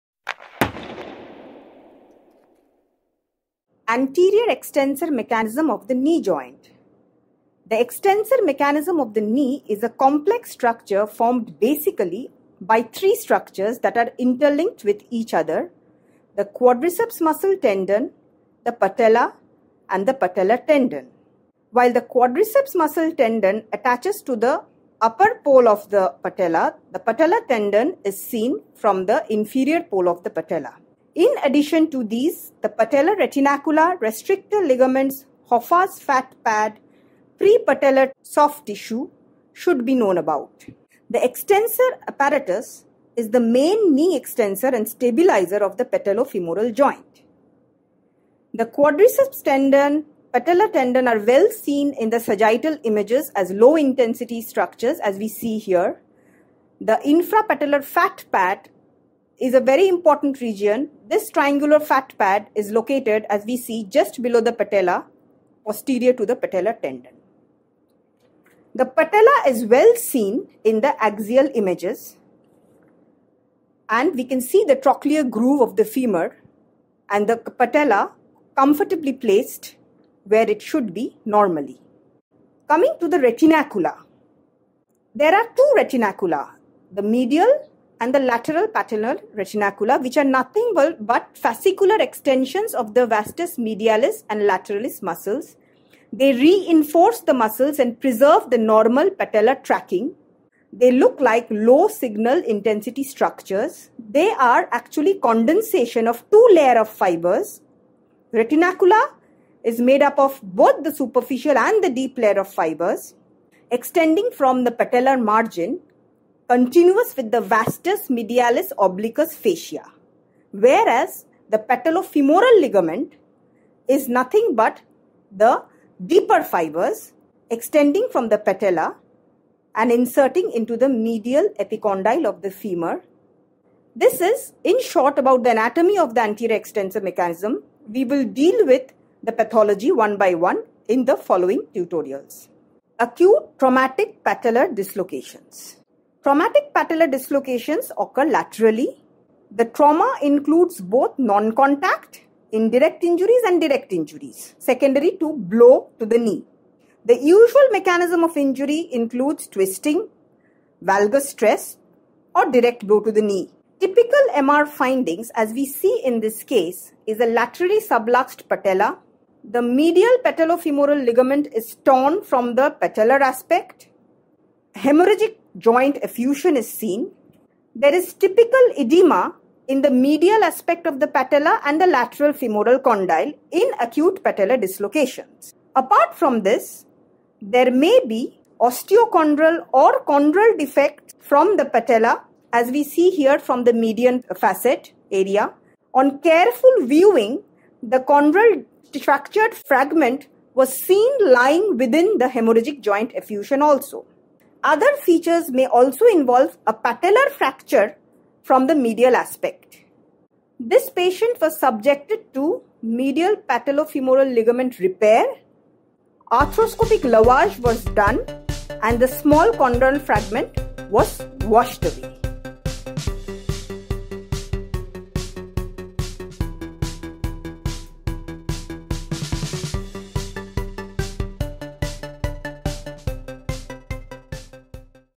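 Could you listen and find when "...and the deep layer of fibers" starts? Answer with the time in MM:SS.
01:51.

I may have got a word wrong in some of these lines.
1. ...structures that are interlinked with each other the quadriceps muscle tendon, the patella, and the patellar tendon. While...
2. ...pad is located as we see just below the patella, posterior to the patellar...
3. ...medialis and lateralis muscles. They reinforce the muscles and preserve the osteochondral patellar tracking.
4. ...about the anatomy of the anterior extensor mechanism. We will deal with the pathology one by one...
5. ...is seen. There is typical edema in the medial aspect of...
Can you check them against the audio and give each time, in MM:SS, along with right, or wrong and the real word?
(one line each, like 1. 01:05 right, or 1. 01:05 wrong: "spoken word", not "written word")
1. 00:13 right
2. 01:02 right
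3. 01:33 wrong: "normal", not "osteochondral"
4. 02:15 right
5. 02:56 right.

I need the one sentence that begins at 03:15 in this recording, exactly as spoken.
On careful viewing, the chondral fractured fragment was seen lying within the hemorrhagic joint effusion also.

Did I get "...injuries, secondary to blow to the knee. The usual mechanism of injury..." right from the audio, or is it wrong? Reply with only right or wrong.
right.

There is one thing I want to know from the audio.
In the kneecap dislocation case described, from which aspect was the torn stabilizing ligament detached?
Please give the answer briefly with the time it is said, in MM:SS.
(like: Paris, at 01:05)
Patellar aspect, at 02:52.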